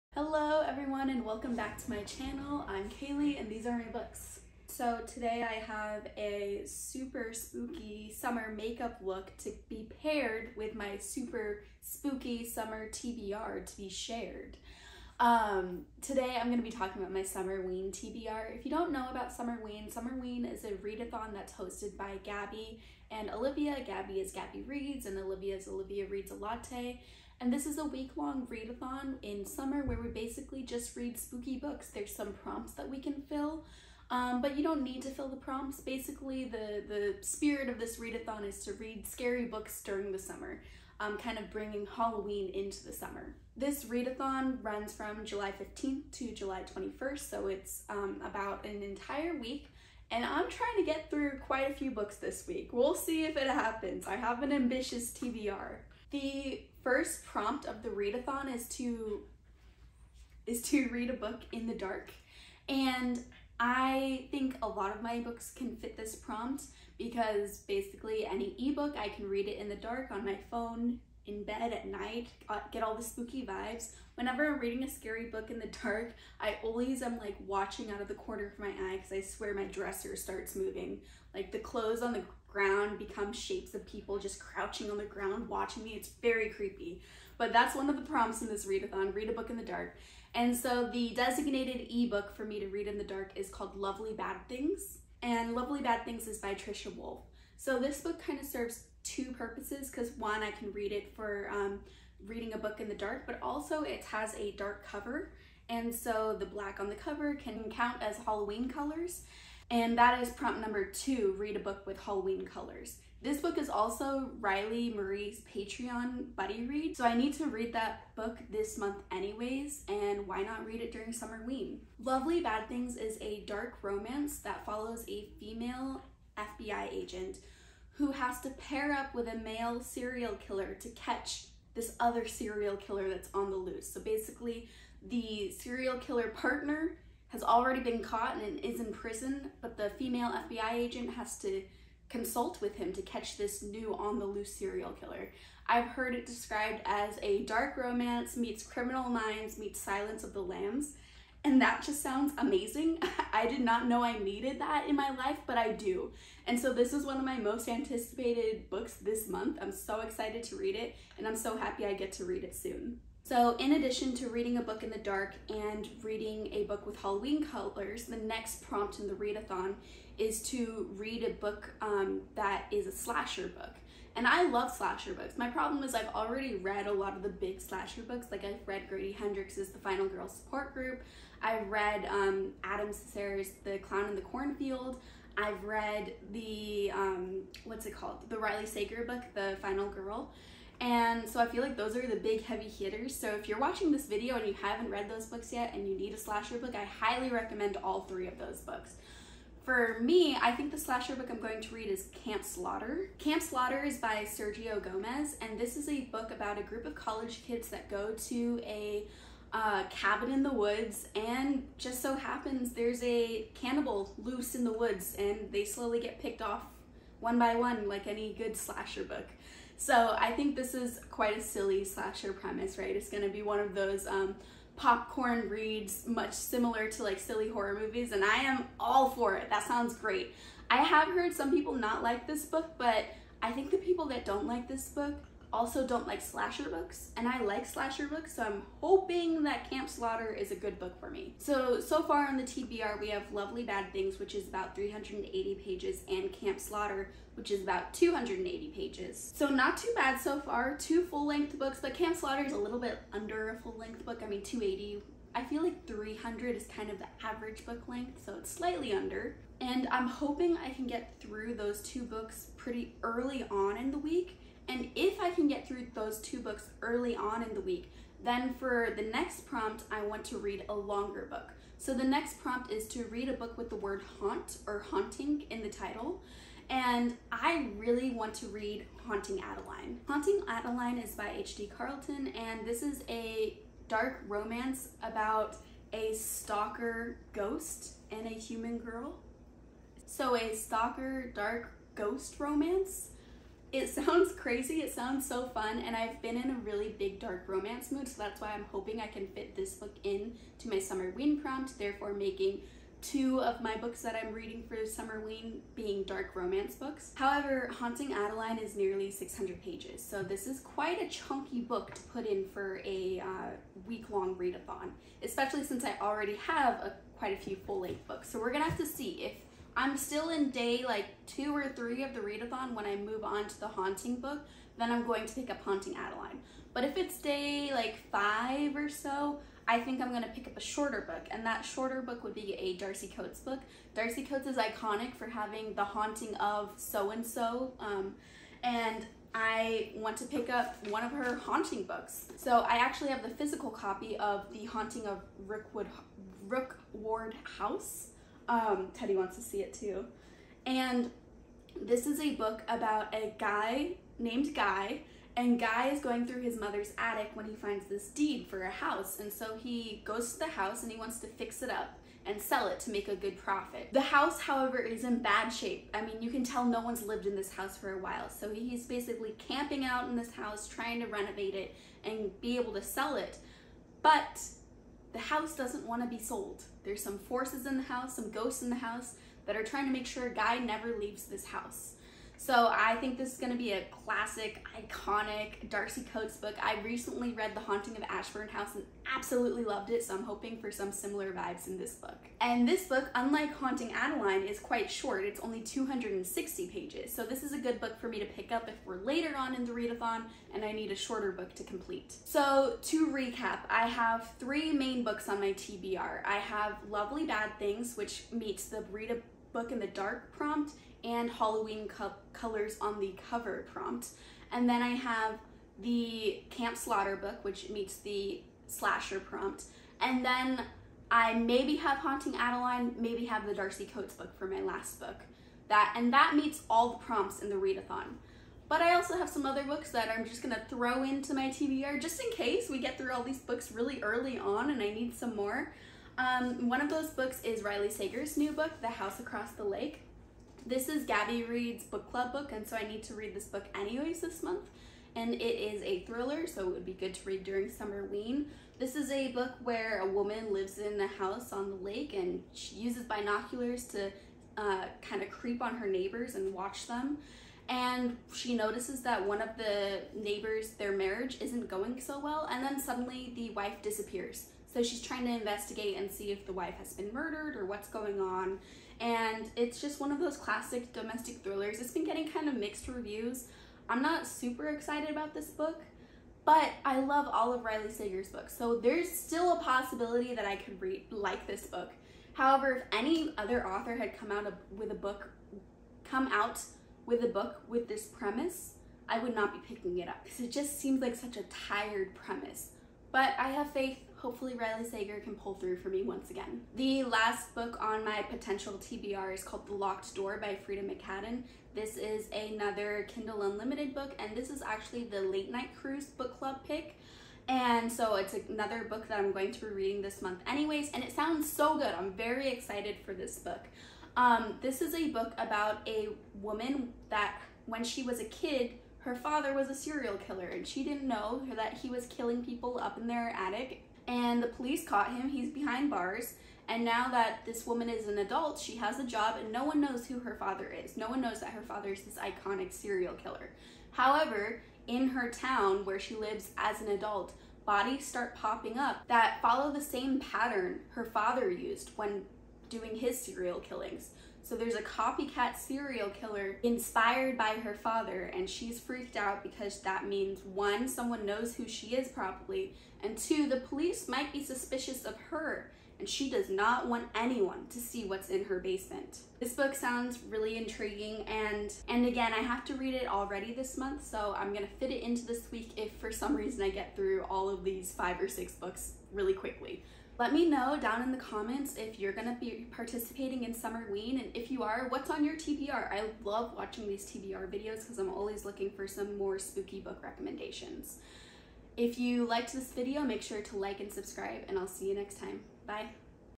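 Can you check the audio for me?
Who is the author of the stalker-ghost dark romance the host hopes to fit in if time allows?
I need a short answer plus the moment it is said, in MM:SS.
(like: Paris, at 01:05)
H.D. Carlton, at 04:41.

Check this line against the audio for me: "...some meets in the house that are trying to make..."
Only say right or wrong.
wrong.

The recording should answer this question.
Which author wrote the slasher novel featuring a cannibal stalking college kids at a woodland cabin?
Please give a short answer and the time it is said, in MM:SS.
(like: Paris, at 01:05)
Sergio Gomez, at 03:24.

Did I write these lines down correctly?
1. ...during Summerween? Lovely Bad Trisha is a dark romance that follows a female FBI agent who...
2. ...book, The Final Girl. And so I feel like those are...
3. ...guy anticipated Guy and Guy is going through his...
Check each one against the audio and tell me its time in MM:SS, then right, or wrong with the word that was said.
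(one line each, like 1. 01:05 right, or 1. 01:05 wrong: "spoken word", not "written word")
1. 02:00 wrong: "Things", not "Trisha"
2. 03:09 right
3. 05:53 wrong: "named", not "anticipated".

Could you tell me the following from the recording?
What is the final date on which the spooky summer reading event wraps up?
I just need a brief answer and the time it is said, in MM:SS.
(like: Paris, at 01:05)
July 21st, at 00:46.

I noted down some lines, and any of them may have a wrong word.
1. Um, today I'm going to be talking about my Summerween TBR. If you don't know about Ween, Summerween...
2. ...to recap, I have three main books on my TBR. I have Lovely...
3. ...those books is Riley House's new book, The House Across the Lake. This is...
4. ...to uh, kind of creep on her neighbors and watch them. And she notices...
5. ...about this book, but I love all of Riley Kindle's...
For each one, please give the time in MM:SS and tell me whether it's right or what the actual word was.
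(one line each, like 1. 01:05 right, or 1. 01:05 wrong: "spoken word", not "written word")
1. 00:15 wrong: "Summerween", not "Ween"
2. 06:42 right
3. 07:16 wrong: "Sager", not "House"
4. 07:33 right
5. 07:55 wrong: "Sager", not "Kindle".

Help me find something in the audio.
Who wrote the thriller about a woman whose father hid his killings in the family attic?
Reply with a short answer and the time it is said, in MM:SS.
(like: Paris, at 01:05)
Freida McFadden, at 08:20.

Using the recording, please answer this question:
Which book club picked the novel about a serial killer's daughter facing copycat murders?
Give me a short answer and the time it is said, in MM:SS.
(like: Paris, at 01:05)
Late Night Cruise, at 08:25.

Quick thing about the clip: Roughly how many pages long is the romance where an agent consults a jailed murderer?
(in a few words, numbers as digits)
380.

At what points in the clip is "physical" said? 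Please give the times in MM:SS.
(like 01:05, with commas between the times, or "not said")
05:43.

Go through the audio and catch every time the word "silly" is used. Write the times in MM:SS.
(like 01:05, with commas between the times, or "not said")
03:41, 03:47.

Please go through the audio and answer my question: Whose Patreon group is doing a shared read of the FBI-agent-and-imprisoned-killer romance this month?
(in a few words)
Riley Marie.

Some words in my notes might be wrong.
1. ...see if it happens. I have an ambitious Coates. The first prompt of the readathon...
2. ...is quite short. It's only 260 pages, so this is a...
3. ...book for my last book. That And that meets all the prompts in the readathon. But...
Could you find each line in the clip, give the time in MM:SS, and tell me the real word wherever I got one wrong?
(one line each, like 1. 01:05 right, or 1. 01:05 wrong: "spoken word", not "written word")
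1. 00:52 wrong: "TBR", not "Coates"
2. 06:34 right
3. 07:04 right.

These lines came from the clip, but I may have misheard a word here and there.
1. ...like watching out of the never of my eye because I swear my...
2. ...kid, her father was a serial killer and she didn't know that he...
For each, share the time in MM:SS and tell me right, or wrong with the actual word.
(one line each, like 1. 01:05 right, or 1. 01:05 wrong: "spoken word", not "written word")
1. 01:17 wrong: "corner", not "never"
2. 08:38 right.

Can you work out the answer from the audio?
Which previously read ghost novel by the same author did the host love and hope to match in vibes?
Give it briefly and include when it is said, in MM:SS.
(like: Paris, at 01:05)
The Haunting of Ashburn House, at 06:27.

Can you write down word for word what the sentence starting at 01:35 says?
And Lovely Bad Things is by Trisha Wolfe.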